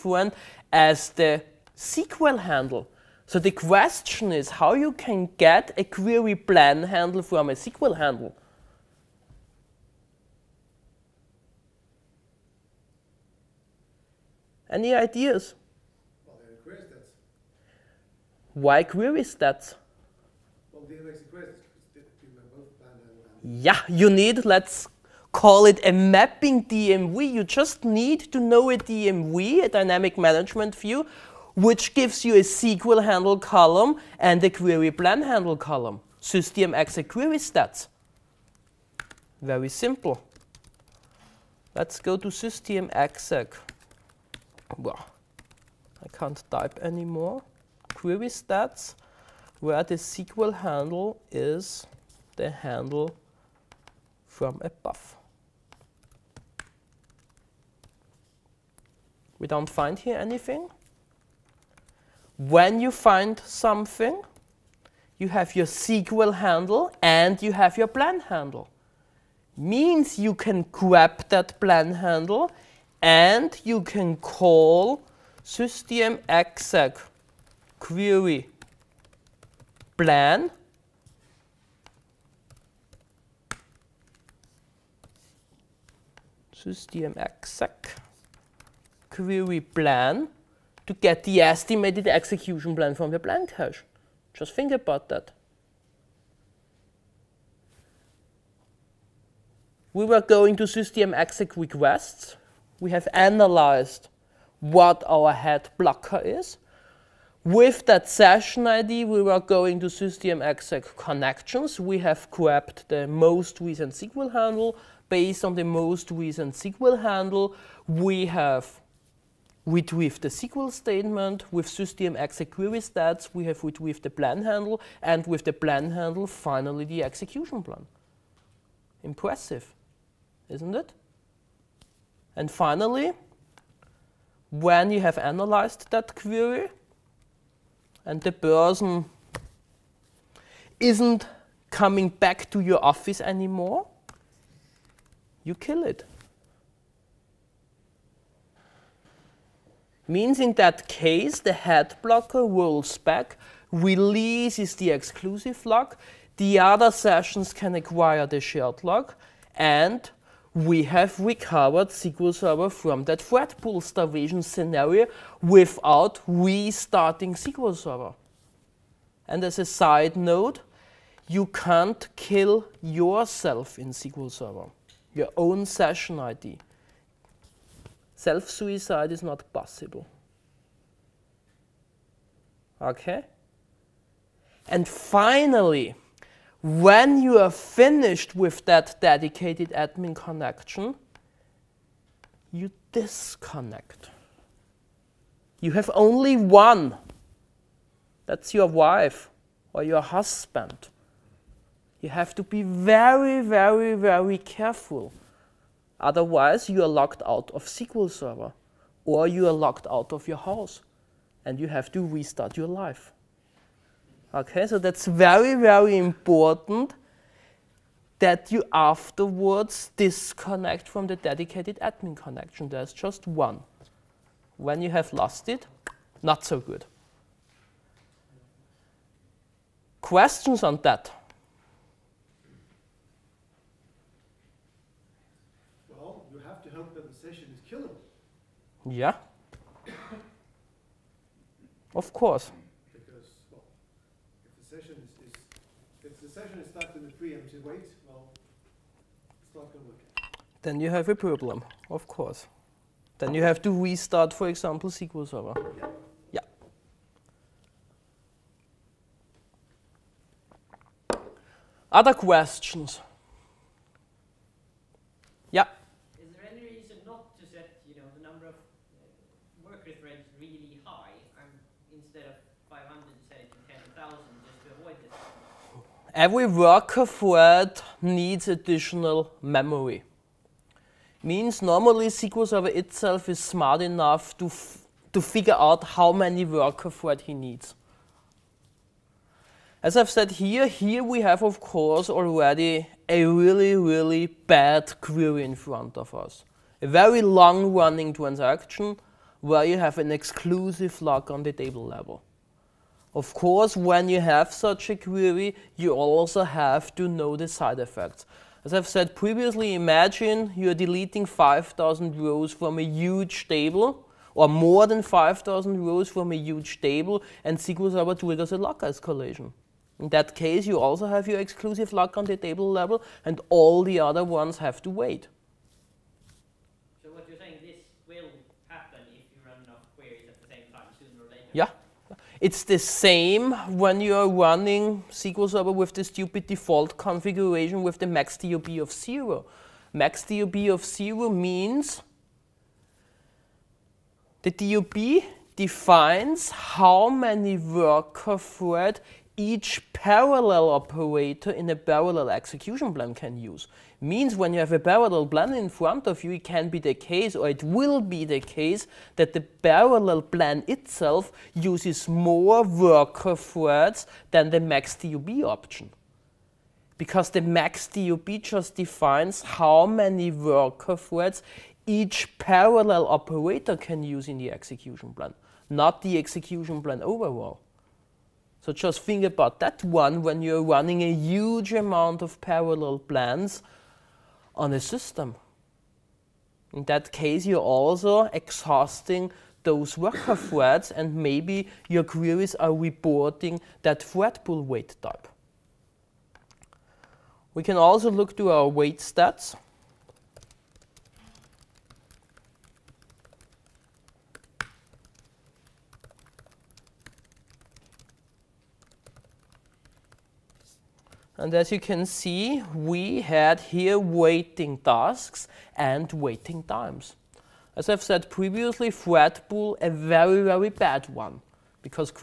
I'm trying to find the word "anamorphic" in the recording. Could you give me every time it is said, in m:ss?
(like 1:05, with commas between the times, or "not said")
not said.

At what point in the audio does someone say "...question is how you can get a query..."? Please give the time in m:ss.
0:03.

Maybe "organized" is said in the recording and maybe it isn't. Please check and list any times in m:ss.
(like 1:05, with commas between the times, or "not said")
not said.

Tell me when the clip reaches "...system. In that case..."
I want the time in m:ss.
6:24.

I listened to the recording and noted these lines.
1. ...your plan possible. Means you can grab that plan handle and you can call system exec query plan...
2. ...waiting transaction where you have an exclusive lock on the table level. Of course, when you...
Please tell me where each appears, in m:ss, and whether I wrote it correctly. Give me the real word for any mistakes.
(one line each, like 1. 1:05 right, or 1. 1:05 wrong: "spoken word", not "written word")
1. 1:07 wrong: "handle", not "possible"
2. 4:57 wrong: "running", not "waiting".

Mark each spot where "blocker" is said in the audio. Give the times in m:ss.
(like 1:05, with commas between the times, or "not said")
1:45, 2:32.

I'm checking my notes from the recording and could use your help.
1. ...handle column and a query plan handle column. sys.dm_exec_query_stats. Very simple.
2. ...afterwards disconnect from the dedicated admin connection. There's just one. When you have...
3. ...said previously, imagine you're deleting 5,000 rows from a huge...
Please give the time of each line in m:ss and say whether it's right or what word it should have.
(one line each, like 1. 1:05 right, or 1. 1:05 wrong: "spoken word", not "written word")
1. 0:33 right
2. 3:38 right
3. 5:08 right.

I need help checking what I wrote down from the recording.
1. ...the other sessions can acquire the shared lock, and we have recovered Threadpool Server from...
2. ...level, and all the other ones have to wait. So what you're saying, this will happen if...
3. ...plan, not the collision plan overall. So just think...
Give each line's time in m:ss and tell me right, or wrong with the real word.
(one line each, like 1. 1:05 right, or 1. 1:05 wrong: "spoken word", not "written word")
1. 2:36 wrong: "SQL", not "Threadpool"
2. 5:22 right
3. 6:15 wrong: "execution", not "collision".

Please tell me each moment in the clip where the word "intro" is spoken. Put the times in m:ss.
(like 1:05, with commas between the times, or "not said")
not said.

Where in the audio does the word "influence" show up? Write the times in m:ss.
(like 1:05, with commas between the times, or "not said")
not said.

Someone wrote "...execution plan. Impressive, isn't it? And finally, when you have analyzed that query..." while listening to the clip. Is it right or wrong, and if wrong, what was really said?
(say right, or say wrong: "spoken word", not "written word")
right.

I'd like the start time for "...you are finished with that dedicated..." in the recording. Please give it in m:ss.
3:07.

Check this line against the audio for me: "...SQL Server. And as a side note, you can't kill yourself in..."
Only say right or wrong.
right.